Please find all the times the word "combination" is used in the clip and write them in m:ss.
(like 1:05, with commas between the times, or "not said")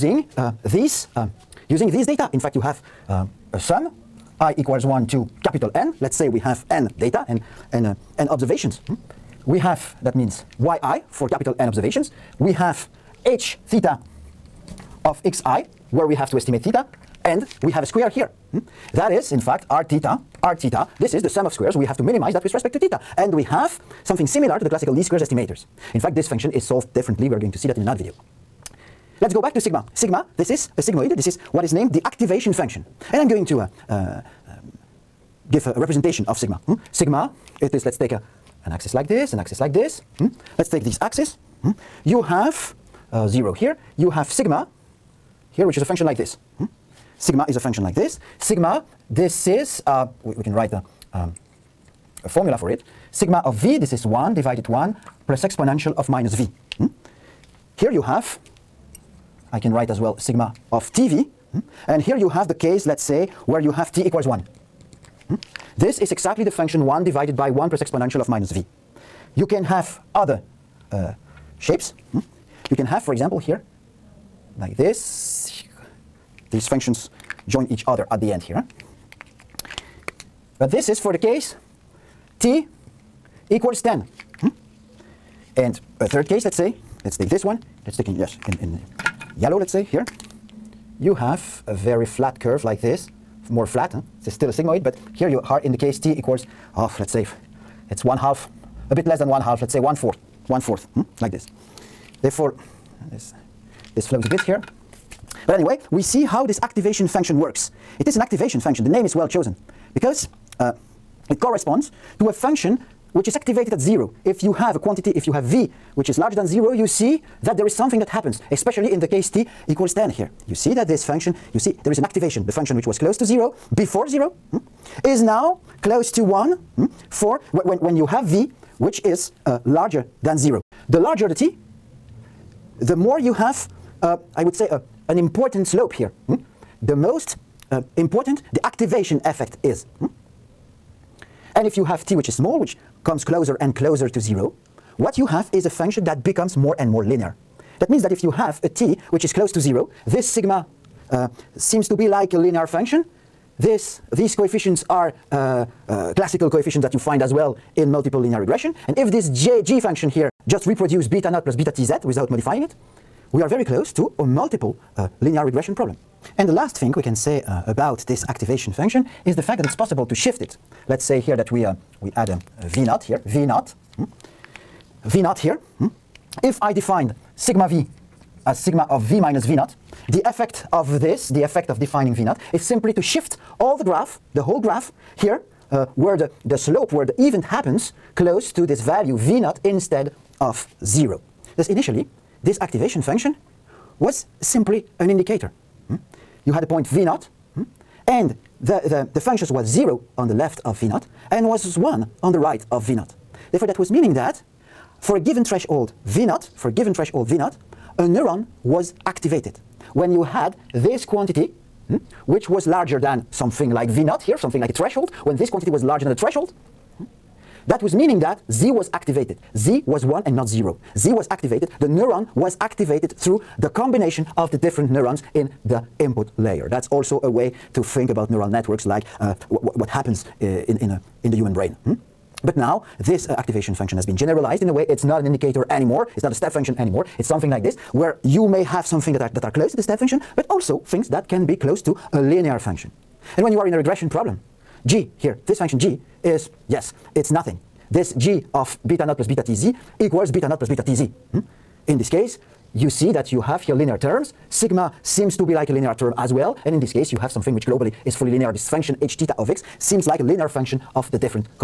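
3:43.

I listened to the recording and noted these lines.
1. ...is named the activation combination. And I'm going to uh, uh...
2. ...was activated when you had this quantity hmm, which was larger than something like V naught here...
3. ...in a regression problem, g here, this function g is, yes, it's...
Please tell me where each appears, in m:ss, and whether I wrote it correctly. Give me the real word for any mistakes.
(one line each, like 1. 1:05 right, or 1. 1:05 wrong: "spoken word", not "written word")
1. 0:31 wrong: "function", not "combination"
2. 3:28 right
3. 4:03 right.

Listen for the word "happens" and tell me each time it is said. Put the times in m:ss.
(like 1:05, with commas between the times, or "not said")
1:58, 3:07, 3:49.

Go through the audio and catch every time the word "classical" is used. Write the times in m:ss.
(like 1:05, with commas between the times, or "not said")
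0:24, 2:36.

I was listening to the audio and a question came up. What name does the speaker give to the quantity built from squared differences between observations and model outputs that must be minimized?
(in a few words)
sum of squares.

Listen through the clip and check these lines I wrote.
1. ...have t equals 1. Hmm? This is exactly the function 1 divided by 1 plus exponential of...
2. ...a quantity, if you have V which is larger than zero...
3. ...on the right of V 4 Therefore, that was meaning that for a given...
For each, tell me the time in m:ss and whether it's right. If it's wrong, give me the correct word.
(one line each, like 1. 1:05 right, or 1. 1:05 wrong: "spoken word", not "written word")
1. 1:03 right
2. 1:54 right
3. 3:22 wrong: "0", not "4".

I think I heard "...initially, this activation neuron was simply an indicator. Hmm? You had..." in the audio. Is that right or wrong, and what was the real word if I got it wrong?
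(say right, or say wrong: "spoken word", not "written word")
wrong: "function", not "neuron".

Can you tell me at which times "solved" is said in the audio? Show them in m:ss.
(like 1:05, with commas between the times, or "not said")
0:26.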